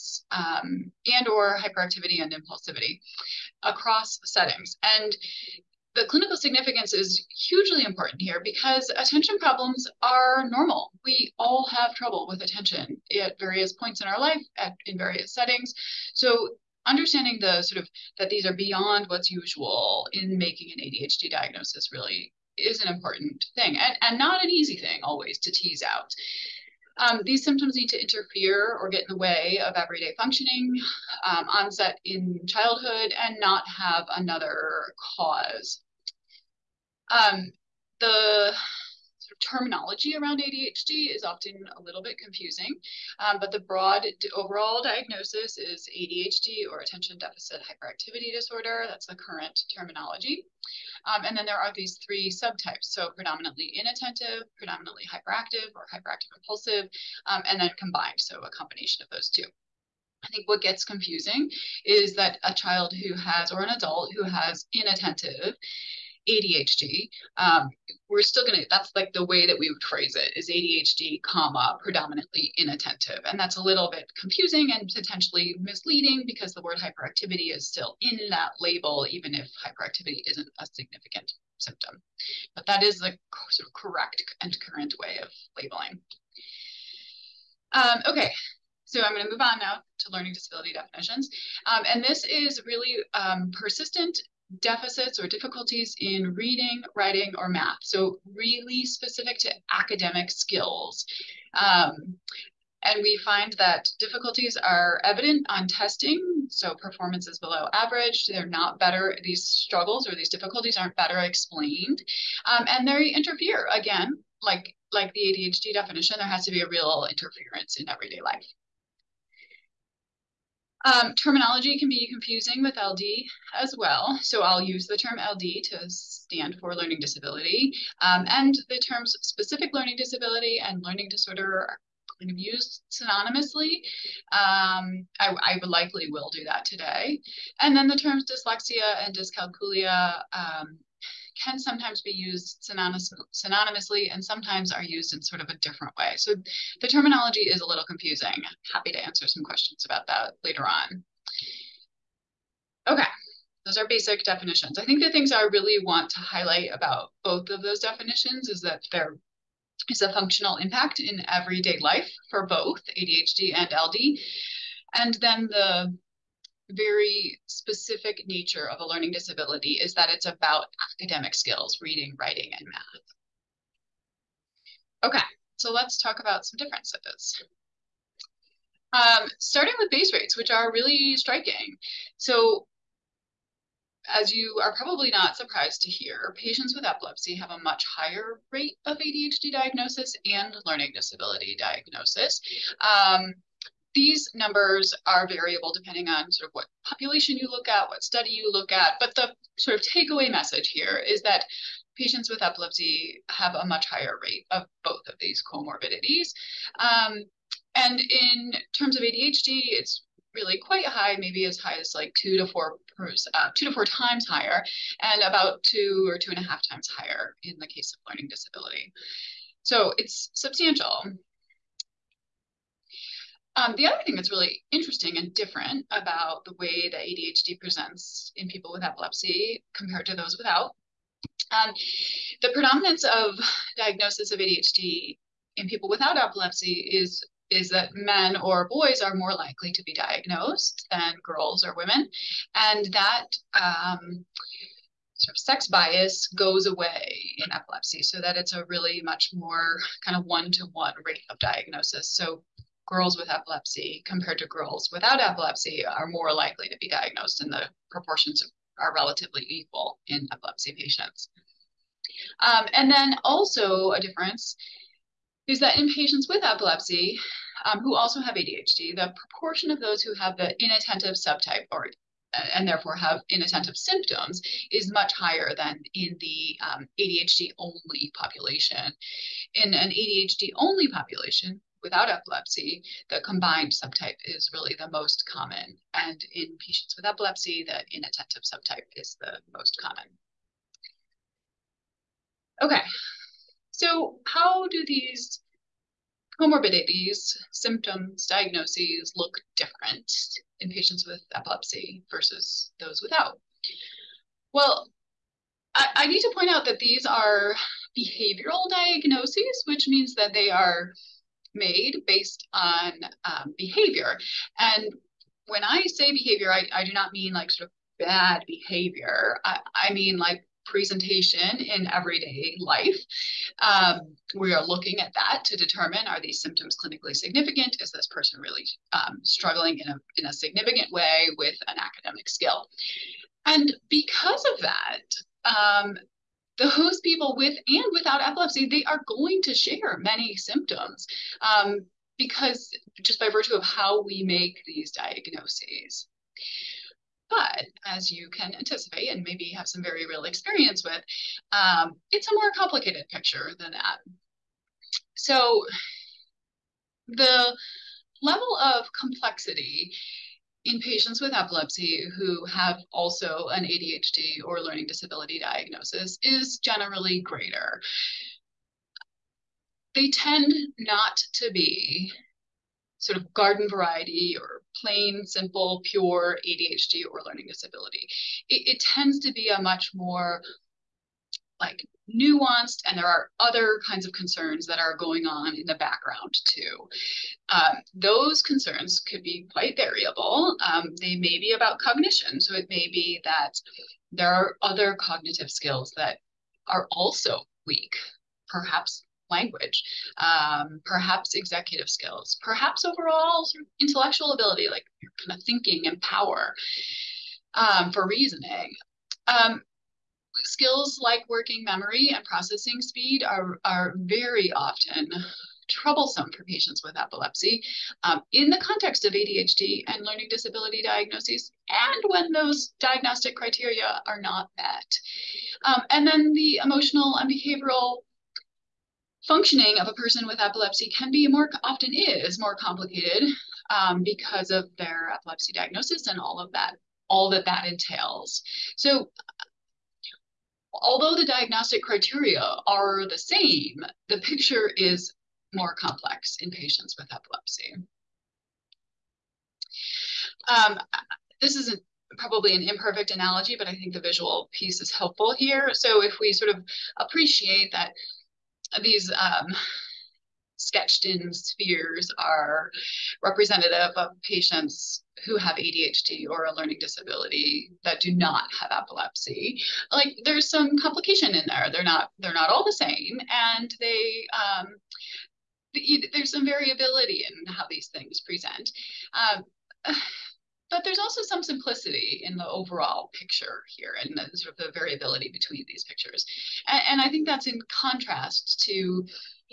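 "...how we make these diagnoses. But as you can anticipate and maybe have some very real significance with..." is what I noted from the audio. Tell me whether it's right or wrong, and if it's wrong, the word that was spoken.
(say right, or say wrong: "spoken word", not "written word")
wrong: "experience", not "significance".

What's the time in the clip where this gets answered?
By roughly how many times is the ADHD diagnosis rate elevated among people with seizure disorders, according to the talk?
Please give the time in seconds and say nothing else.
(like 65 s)
213 s.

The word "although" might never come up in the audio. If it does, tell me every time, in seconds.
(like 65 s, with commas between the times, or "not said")
440 s.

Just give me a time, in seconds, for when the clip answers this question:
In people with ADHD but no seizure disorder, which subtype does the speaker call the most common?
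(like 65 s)
283 s.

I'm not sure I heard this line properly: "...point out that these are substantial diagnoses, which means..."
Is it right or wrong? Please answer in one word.
wrong.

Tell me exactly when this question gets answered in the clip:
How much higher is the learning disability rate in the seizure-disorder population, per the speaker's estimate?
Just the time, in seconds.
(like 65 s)
215 s.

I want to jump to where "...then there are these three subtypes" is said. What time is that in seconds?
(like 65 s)
51 s.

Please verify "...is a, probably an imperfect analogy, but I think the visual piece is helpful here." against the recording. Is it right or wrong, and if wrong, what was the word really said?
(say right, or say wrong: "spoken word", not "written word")
right.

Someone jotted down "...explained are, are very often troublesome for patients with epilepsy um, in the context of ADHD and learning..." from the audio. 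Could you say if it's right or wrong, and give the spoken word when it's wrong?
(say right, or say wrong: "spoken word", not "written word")
wrong: "speed", not "explained".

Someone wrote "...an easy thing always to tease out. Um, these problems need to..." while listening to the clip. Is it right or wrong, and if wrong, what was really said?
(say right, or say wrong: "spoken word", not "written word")
wrong: "symptoms", not "problems".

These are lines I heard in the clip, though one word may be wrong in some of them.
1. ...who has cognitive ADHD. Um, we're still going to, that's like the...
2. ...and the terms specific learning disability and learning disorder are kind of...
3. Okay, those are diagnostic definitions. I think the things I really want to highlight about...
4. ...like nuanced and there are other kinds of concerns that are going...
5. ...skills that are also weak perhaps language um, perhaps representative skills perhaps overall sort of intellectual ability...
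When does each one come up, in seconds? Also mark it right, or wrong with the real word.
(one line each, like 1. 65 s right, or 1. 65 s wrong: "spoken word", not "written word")
1. 64 s wrong: "inattentive", not "cognitive"
2. 128 s right
3. 152 s wrong: "basic", not "diagnostic"
4. 381 s right
5. 395 s wrong: "executive", not "representative".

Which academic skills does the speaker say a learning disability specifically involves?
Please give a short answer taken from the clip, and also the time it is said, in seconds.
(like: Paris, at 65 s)
reading, writing, or math, at 96 s.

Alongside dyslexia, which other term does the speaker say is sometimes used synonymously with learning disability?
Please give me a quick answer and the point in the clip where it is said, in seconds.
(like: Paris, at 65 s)
dyscalculia, at 139 s.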